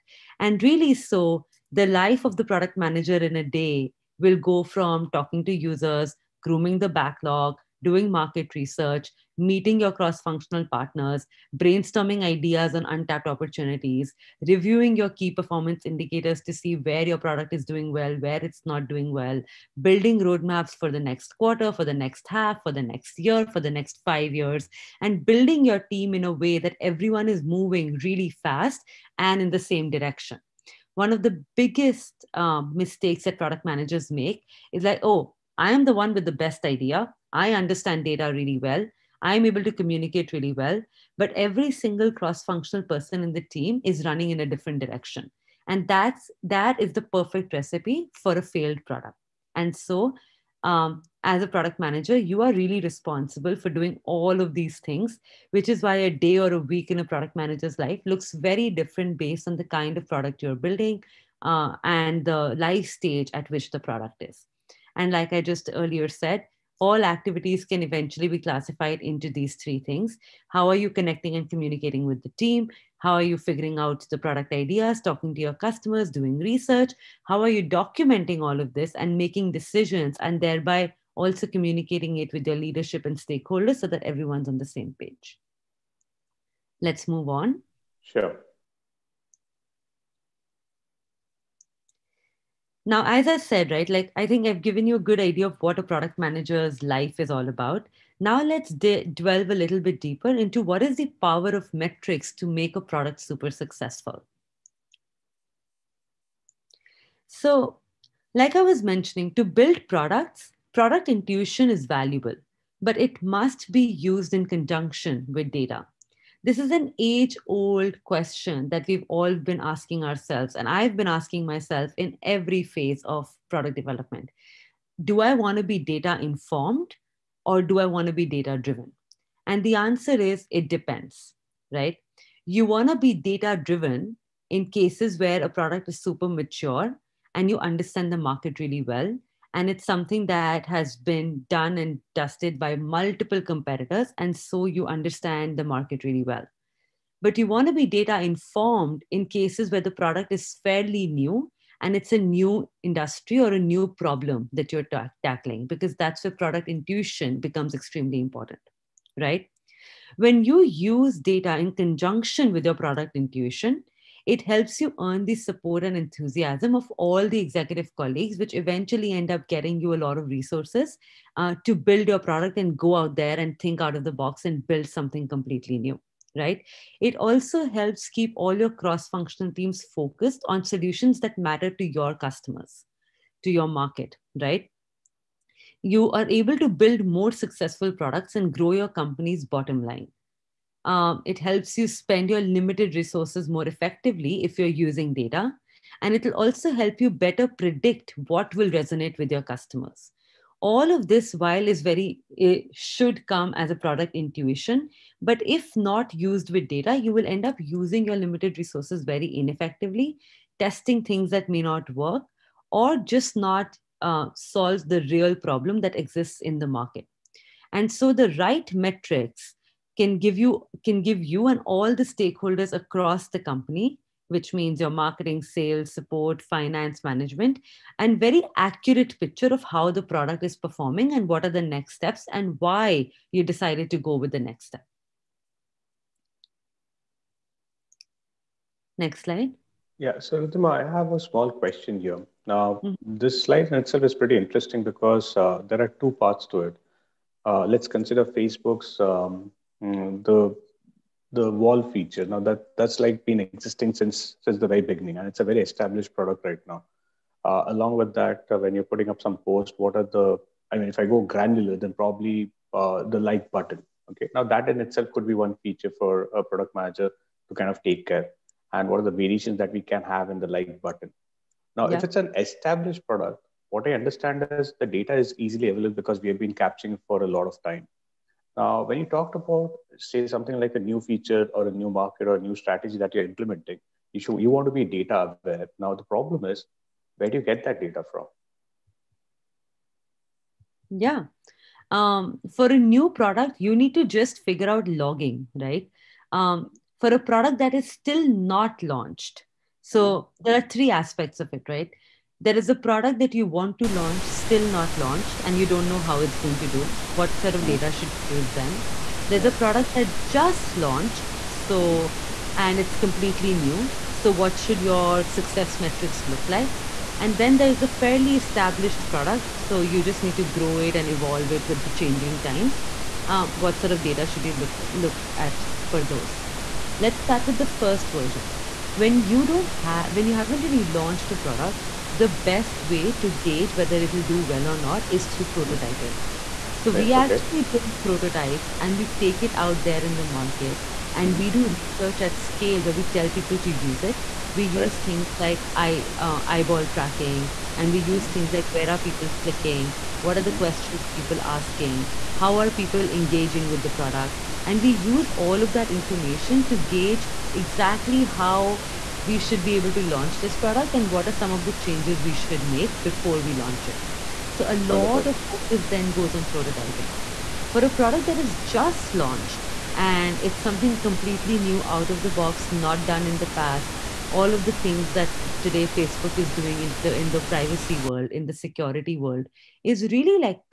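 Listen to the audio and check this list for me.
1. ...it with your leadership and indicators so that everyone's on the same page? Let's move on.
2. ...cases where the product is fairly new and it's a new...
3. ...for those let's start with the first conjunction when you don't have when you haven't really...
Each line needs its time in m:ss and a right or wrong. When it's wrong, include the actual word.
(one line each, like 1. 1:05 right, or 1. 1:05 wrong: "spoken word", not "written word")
1. 1:22 wrong: "stakeholders", not "indicators"
2. 2:29 right
3. 5:25 wrong: "version", not "conjunction".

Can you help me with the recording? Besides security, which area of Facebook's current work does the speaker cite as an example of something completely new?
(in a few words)
privacy.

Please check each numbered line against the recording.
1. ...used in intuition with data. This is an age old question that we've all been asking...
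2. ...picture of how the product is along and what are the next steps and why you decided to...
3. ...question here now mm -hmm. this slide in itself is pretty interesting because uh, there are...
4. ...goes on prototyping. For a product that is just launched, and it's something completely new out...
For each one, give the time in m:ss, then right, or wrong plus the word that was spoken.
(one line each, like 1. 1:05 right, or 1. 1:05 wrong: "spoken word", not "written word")
1. 1:53 wrong: "conjunction", not "intuition"
2. 3:49 wrong: "performing", not "along"
3. 4:01 right
4. 6:06 right.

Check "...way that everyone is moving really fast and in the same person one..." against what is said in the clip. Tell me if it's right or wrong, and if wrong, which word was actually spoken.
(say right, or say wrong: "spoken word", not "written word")
wrong: "direction", not "person".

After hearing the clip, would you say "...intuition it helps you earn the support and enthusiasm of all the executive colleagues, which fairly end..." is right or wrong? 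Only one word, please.
wrong.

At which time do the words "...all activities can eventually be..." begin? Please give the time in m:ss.
1:06.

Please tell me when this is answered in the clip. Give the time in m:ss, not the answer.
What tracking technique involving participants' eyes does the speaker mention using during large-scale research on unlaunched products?
5:46.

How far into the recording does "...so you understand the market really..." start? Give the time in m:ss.
2:24.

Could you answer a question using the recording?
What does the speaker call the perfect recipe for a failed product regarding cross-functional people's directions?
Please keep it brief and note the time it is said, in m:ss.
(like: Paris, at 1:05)
running in a different direction, at 0:44.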